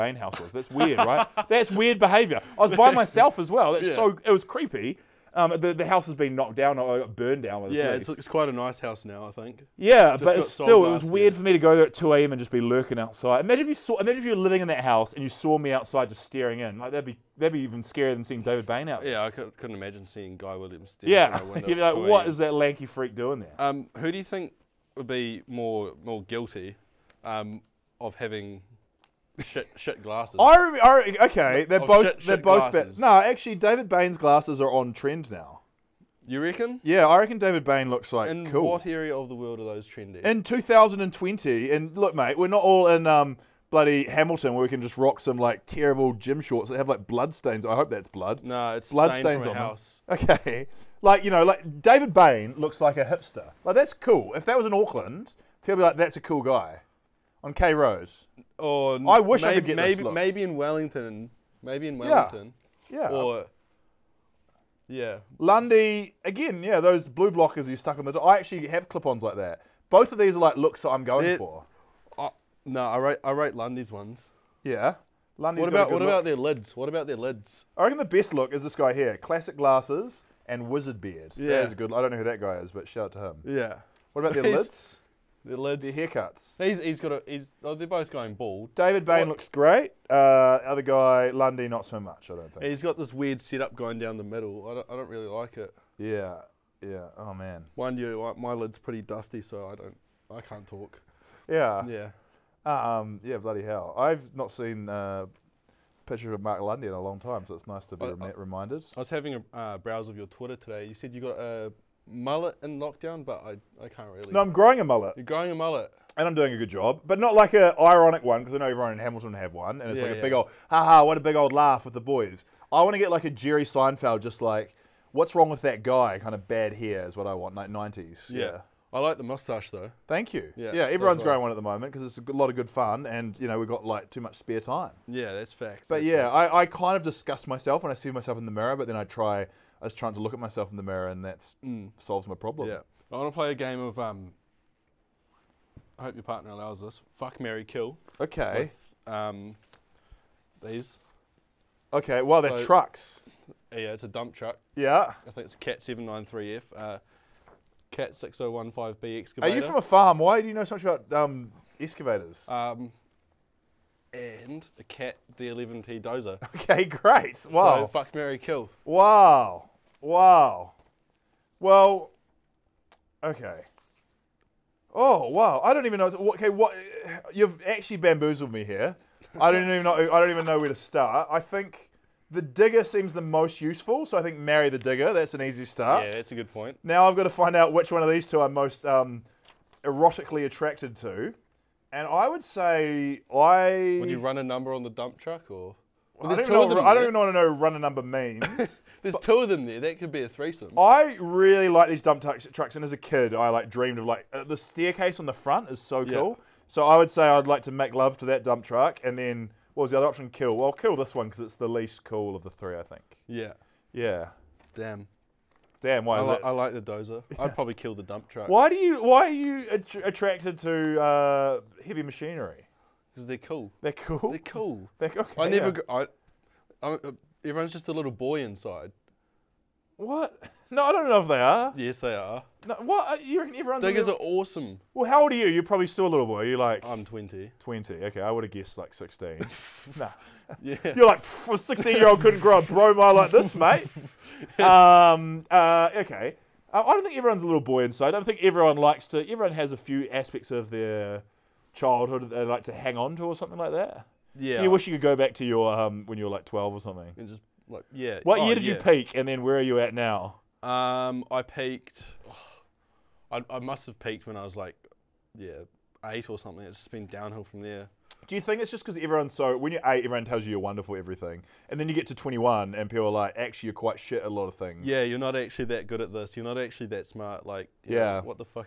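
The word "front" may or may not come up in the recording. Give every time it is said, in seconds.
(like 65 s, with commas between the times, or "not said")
205 s.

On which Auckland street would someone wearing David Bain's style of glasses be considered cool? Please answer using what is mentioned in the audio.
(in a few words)
K Road.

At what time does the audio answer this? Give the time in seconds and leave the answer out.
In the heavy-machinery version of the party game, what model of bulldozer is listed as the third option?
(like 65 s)
164 s.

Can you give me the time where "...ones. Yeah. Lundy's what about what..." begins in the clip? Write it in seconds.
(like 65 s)
73 s.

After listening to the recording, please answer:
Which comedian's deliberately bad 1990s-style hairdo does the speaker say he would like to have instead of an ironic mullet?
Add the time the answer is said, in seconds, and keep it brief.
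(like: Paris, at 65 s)
Jerry Seinfeld, at 123 s.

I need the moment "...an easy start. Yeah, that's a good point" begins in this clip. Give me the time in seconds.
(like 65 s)
185 s.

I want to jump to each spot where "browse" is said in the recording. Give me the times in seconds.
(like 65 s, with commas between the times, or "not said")
109 s.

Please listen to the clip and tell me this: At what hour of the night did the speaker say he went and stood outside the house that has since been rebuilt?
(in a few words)
2 a.m.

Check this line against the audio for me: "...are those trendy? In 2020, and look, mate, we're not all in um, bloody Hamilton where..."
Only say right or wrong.
right.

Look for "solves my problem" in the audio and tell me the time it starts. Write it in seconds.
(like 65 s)
141 s.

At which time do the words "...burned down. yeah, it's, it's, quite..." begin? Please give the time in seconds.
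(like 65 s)
7 s.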